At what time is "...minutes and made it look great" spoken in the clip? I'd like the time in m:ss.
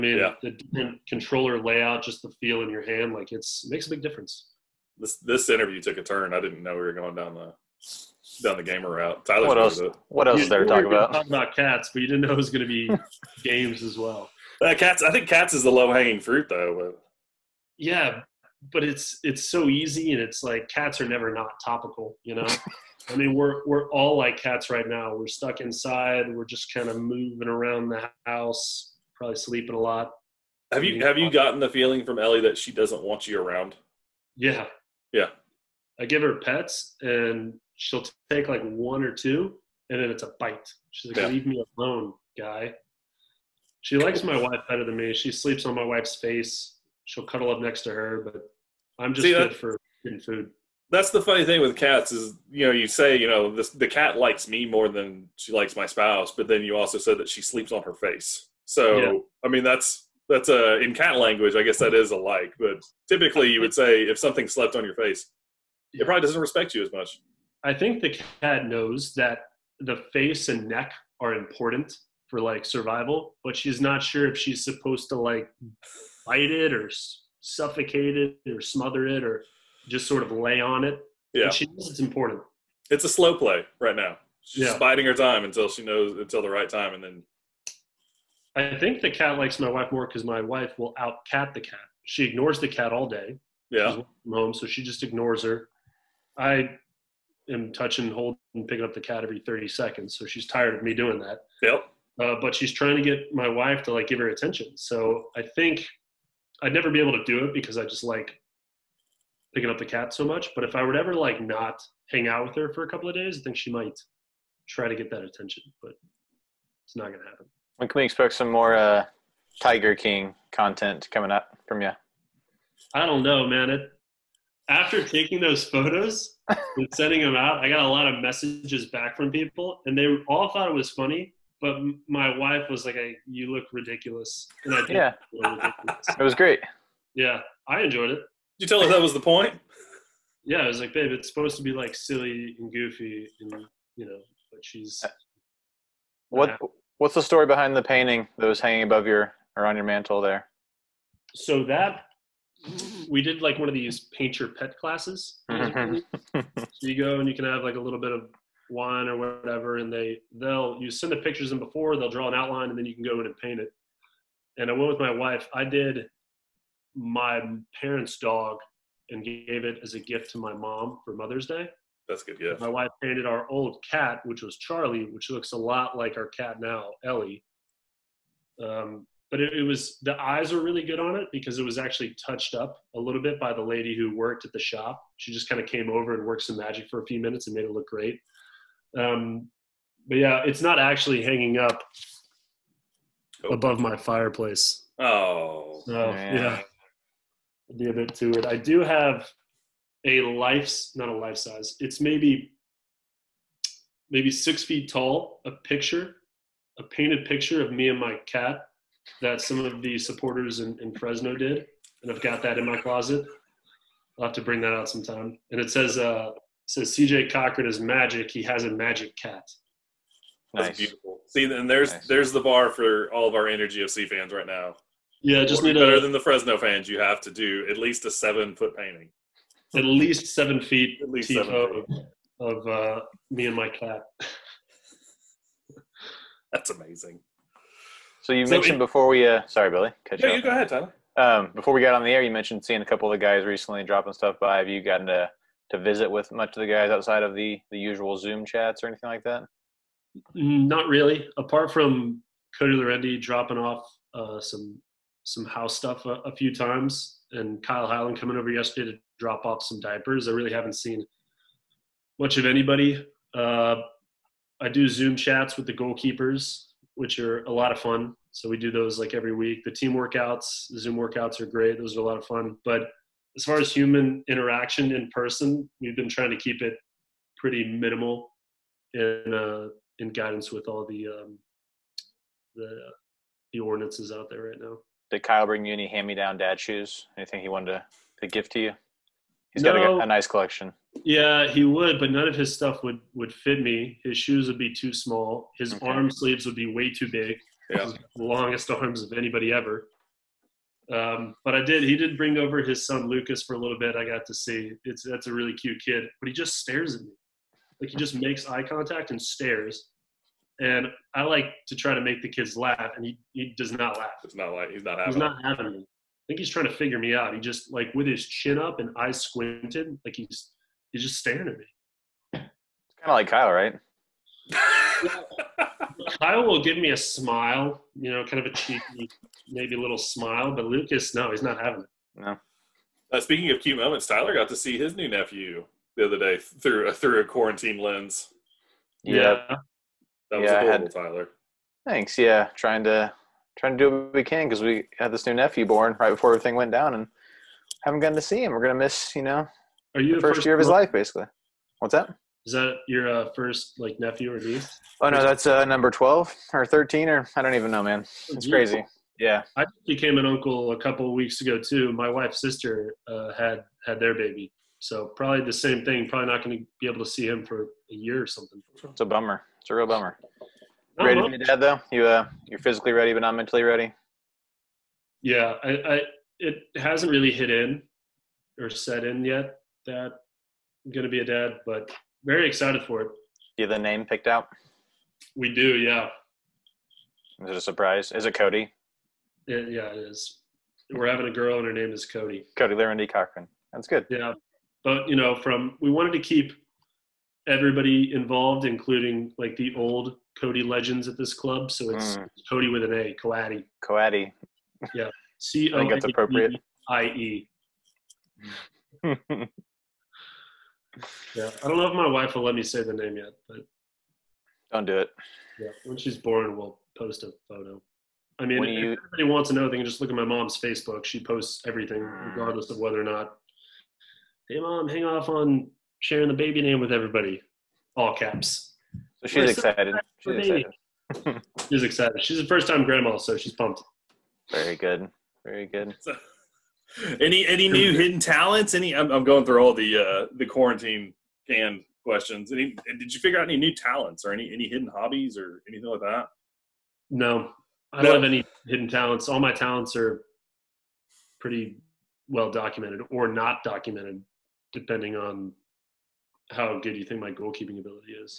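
3:07.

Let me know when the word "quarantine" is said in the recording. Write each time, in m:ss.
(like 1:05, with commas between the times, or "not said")
5:37, 7:20.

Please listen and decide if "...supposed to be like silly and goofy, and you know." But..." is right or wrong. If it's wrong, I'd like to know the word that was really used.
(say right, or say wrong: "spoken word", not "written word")
right.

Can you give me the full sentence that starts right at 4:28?
So we do those like every week.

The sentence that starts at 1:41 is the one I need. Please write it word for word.
Yep uh, but she's trying to get my wife to like give her attention.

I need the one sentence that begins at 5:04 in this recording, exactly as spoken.
It's that's a really cute kid, but he just stares at me.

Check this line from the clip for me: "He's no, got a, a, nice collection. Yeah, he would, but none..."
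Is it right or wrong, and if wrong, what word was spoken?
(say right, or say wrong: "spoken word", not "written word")
right.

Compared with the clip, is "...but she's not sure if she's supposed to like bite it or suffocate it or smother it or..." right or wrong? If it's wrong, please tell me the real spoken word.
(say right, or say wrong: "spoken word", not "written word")
right.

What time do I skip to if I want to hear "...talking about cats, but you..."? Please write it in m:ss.
0:11.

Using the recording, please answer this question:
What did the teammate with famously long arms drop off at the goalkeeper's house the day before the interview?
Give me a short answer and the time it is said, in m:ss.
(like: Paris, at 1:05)
Diapers, at 4:19.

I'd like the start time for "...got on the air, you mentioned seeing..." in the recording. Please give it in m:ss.
4:01.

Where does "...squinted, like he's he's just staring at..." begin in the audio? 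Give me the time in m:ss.
5:19.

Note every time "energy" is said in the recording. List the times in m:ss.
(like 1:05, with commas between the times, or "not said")
3:43.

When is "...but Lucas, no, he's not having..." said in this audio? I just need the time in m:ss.
5:30.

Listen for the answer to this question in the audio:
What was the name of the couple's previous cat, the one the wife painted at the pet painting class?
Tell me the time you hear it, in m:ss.
2:54.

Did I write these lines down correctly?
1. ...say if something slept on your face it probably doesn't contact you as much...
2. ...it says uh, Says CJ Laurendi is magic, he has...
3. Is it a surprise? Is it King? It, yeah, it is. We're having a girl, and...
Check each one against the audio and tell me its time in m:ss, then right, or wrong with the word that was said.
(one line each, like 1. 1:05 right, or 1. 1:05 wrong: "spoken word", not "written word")
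1. 1:03 wrong: "respect", not "contact"
2. 3:35 wrong: "Cochran", not "Laurendi"
3. 6:27 wrong: "Cody", not "King".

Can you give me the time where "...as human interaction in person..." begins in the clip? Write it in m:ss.
4:33.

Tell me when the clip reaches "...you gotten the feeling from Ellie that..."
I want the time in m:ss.
0:31.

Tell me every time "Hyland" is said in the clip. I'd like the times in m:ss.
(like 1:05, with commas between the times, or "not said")
4:17.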